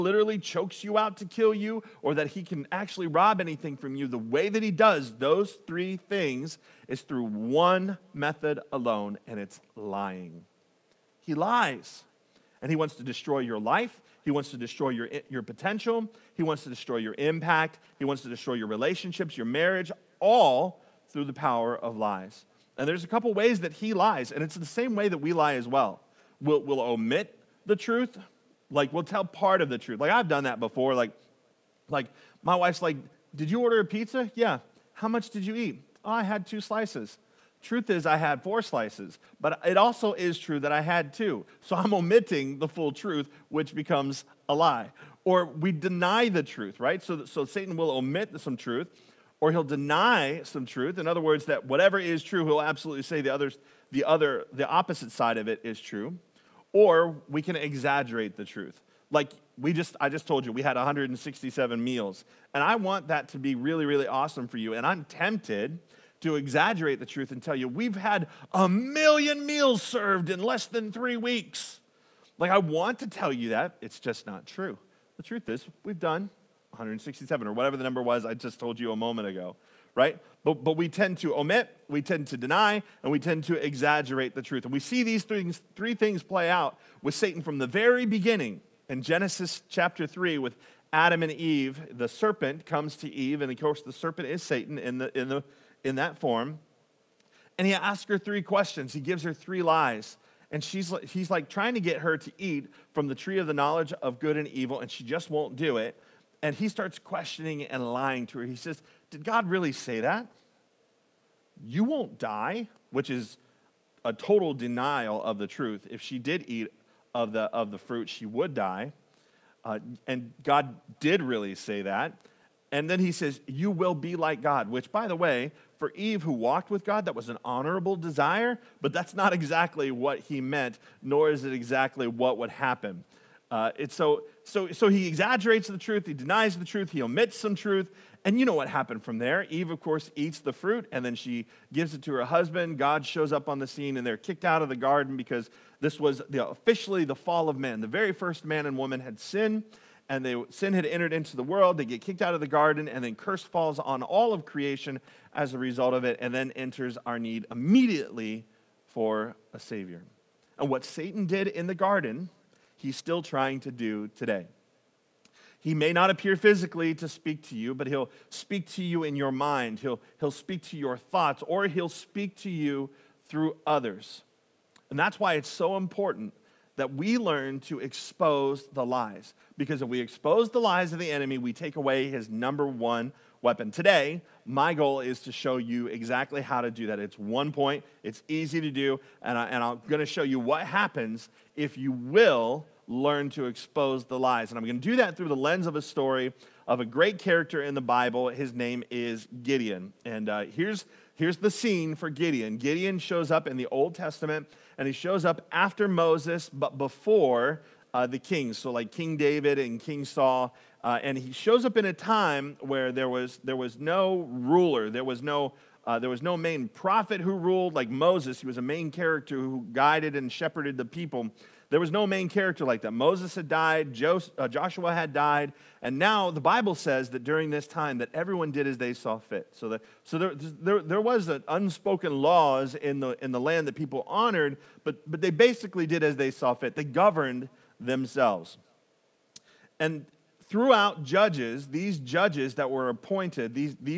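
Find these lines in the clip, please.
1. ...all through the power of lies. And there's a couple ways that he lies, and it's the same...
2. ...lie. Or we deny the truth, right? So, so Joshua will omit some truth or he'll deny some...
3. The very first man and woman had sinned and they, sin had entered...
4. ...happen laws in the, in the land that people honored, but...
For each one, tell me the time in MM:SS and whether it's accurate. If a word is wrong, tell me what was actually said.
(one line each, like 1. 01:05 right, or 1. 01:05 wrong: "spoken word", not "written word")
1. 00:20 right
2. 00:44 wrong: "Satan", not "Joshua"
3. 02:27 right
4. 03:51 wrong: "unspoken", not "happen".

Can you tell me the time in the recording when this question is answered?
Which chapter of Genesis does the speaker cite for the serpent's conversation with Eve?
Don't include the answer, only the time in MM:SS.
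01:29.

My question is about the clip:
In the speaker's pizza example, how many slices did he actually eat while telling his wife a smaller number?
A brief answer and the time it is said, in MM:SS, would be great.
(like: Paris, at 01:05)
4, at 00:38.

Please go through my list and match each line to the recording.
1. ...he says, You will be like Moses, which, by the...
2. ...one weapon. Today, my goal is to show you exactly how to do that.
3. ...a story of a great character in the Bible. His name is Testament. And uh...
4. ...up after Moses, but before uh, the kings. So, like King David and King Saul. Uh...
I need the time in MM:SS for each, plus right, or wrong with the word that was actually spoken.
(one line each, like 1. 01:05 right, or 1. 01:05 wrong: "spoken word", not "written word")
1. 02:02 wrong: "God", not "Moses"
2. 03:02 right
3. 03:15 wrong: "Gideon", not "Testament"
4. 03:25 right.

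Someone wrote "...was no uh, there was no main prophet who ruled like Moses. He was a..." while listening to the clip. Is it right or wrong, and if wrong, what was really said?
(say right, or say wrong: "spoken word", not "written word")
right.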